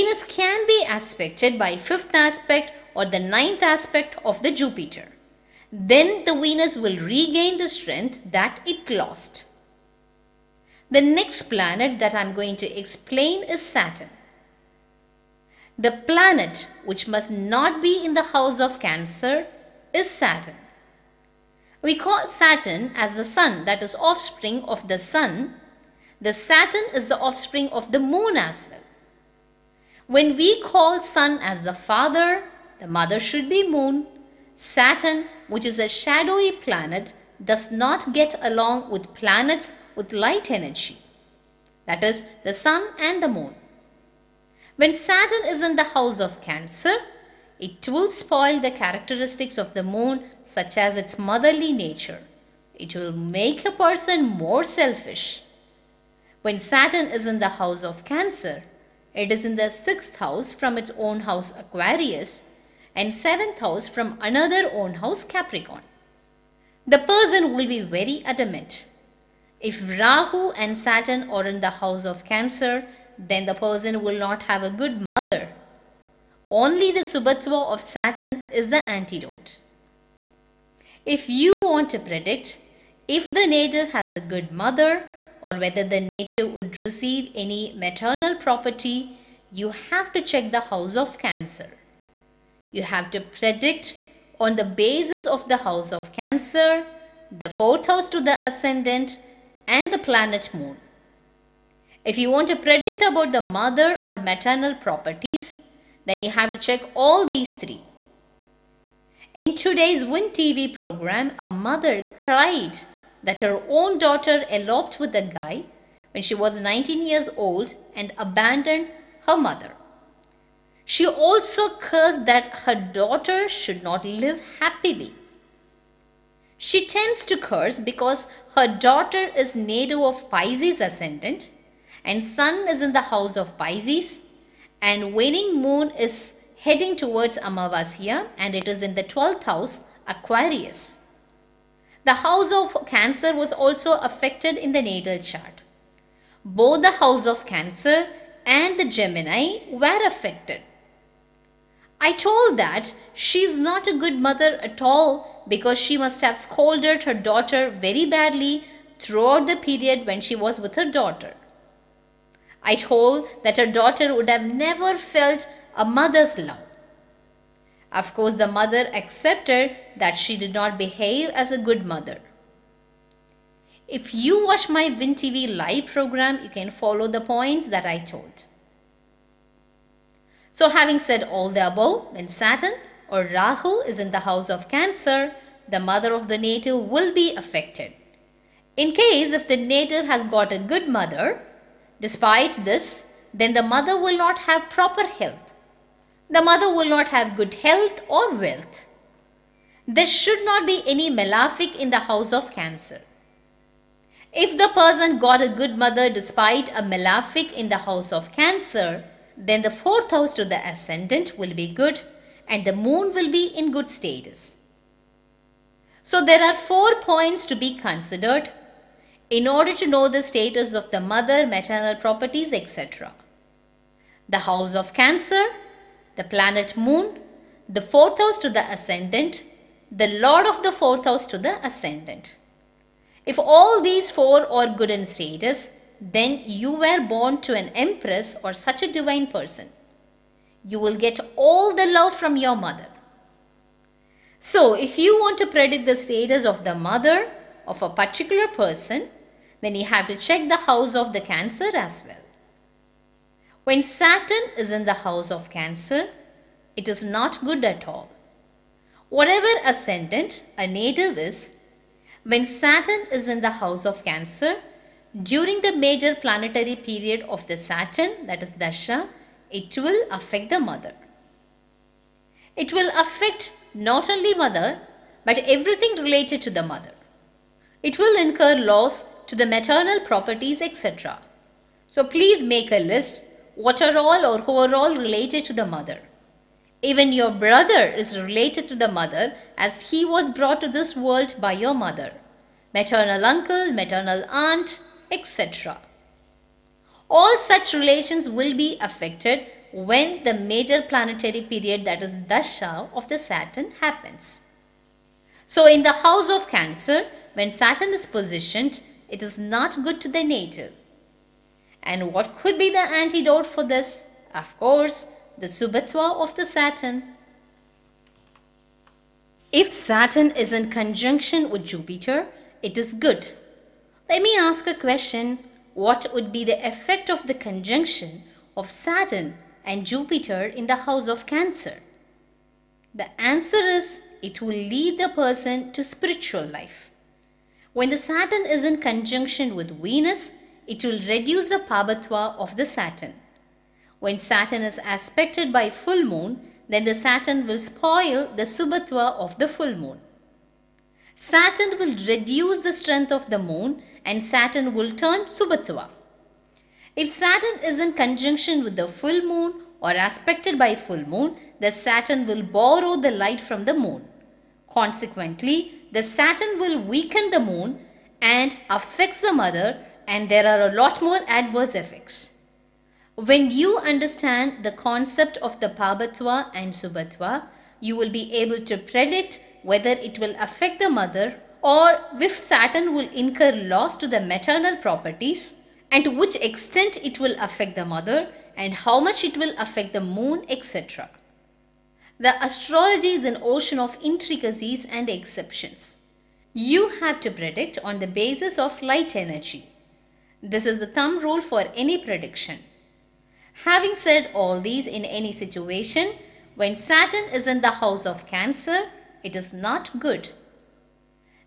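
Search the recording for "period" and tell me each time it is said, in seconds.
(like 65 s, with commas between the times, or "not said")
159 s, 266 s, 301 s.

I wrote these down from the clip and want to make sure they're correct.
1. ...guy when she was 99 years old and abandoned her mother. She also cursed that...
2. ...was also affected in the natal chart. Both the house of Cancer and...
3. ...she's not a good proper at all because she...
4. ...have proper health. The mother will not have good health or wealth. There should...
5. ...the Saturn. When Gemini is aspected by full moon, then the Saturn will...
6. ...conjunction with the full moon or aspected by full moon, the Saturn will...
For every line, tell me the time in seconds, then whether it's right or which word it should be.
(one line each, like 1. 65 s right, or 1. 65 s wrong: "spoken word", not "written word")
1. 115 s wrong: "19", not "99"
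2. 143 s right
3. 153 s wrong: "mother", not "proper"
4. 194 s right
5. 342 s wrong: "Saturn", not "Gemini"
6. 357 s right.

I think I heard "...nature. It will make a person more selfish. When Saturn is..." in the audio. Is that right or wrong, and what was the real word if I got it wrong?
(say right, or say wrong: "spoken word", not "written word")
right.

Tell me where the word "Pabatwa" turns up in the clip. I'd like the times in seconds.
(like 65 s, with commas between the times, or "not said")
341 s, 375 s.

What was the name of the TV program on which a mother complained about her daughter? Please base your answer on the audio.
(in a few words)
Win TV.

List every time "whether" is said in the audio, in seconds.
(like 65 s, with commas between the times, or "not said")
85 s, 379 s.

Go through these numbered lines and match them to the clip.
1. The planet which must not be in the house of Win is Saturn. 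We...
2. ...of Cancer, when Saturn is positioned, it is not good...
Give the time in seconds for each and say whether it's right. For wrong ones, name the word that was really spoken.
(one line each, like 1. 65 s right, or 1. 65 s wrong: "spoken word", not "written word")
1. 15 s wrong: "Cancer", not "Win"
2. 306 s right.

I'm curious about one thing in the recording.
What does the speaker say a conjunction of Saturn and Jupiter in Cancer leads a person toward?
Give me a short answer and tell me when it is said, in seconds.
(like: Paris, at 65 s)
spiritual life, at 335 s.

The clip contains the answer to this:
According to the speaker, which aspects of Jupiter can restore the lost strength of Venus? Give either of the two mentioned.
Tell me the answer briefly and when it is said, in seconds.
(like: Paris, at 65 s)
fifth aspect, at 1 s.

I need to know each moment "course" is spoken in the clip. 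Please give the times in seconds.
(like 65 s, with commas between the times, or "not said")
168 s, 314 s.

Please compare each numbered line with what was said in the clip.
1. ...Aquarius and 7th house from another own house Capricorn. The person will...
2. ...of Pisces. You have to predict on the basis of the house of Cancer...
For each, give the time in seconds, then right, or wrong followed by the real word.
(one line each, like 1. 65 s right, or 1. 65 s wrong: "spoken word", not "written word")
1. 61 s right
2. 90 s wrong: "Cancer", not "Pisces".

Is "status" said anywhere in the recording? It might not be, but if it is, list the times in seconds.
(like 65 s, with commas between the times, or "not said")
213 s, 220 s, 235 s, 245 s.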